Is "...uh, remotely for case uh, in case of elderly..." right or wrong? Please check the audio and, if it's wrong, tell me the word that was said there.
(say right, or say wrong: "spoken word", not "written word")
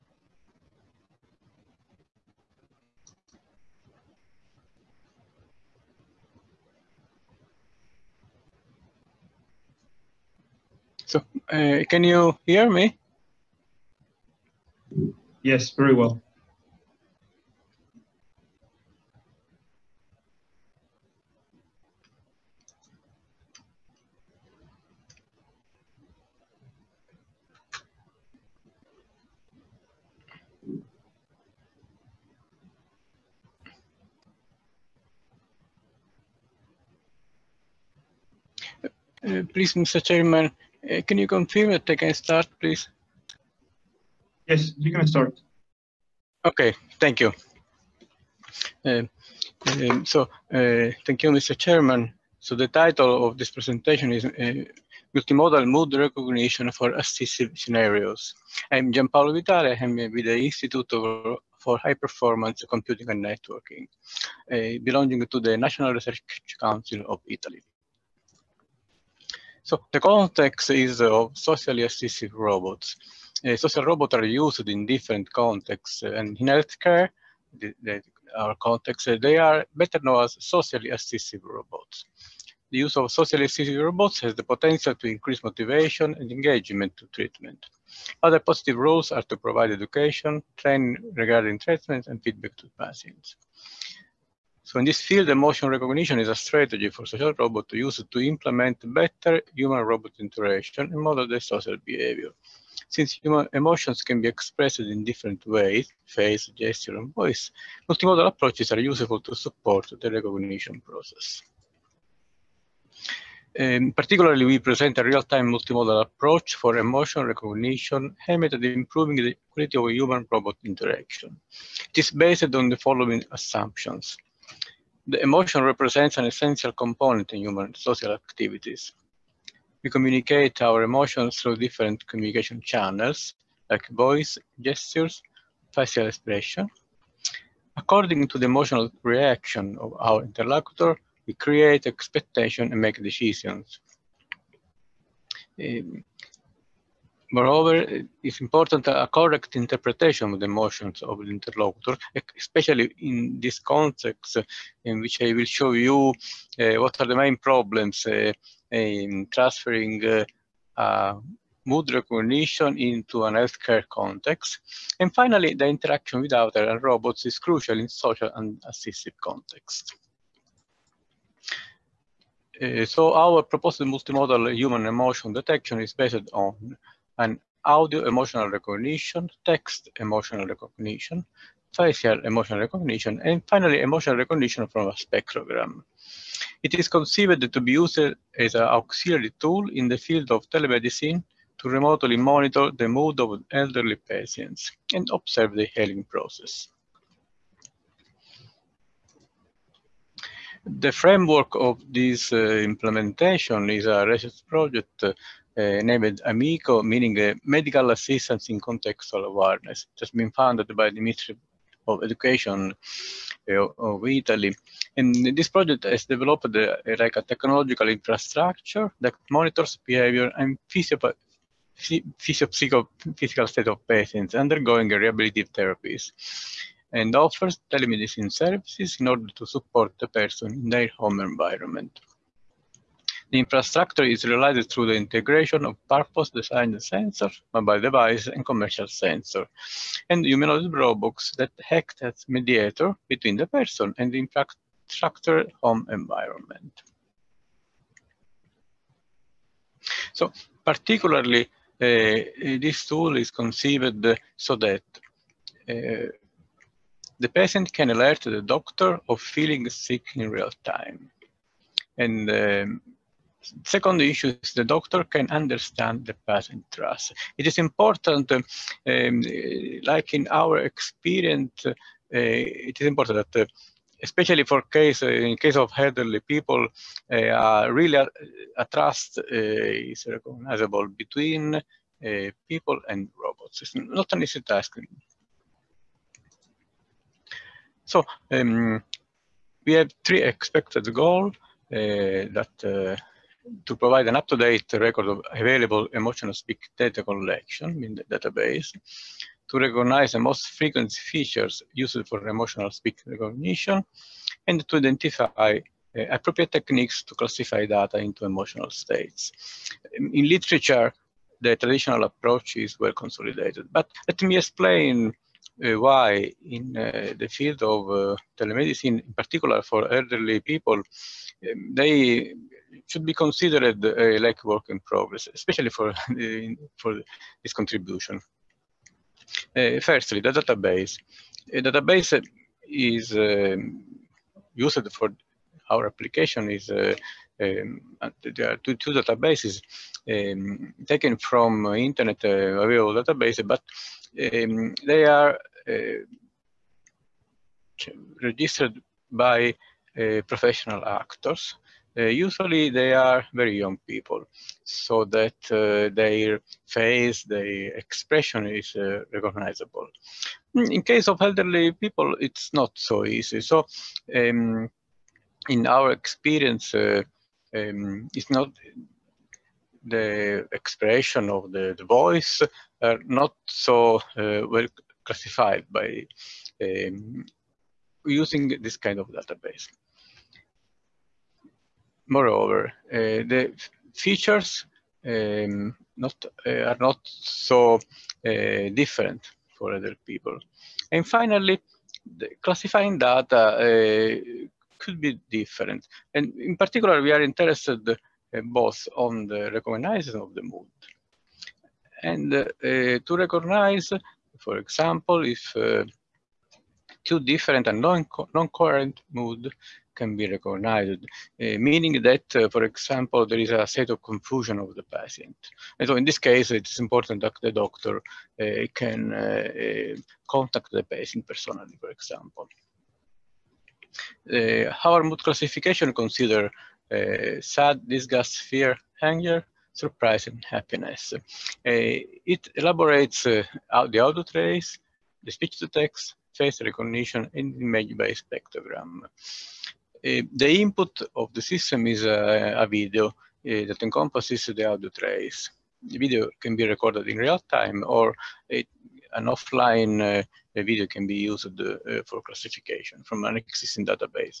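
wrong: "especially", not "remotely".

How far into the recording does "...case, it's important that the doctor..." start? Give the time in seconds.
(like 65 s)
416 s.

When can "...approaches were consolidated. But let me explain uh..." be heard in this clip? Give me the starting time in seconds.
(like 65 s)
312 s.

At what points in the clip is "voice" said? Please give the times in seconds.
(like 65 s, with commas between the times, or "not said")
107 s, 133 s, 371 s.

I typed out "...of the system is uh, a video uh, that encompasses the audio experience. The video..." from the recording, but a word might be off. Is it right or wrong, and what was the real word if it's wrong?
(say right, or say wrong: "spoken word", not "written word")
wrong: "trace", not "experience".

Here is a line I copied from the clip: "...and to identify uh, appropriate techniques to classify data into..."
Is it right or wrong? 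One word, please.
right.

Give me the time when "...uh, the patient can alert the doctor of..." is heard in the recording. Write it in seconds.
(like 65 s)
255 s.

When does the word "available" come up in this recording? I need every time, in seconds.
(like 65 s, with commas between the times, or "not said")
295 s, 342 s.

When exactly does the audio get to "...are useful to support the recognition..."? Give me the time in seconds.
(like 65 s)
108 s.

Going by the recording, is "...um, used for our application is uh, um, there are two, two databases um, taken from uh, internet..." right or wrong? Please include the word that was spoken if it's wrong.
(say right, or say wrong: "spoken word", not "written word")
right.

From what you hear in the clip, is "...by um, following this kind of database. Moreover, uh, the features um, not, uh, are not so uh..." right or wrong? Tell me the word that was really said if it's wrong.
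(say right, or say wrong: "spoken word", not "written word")
wrong: "using", not "following".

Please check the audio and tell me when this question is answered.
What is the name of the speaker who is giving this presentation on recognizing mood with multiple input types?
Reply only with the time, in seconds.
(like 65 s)
58 s.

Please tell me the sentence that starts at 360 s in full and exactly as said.
Mm, in case of elderly people, it's not so easy.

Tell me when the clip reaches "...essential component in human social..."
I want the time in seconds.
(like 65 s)
126 s.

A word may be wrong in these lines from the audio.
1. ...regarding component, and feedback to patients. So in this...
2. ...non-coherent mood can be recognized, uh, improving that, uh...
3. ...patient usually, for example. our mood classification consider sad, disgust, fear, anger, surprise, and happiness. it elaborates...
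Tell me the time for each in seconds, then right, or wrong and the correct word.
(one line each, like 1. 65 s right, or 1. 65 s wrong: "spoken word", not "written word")
1. 91 s wrong: "treatment", not "component"
2. 407 s wrong: "meaning", not "improving"
3. 420 s wrong: "personally", not "usually".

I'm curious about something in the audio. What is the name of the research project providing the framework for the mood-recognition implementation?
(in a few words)
AMICO.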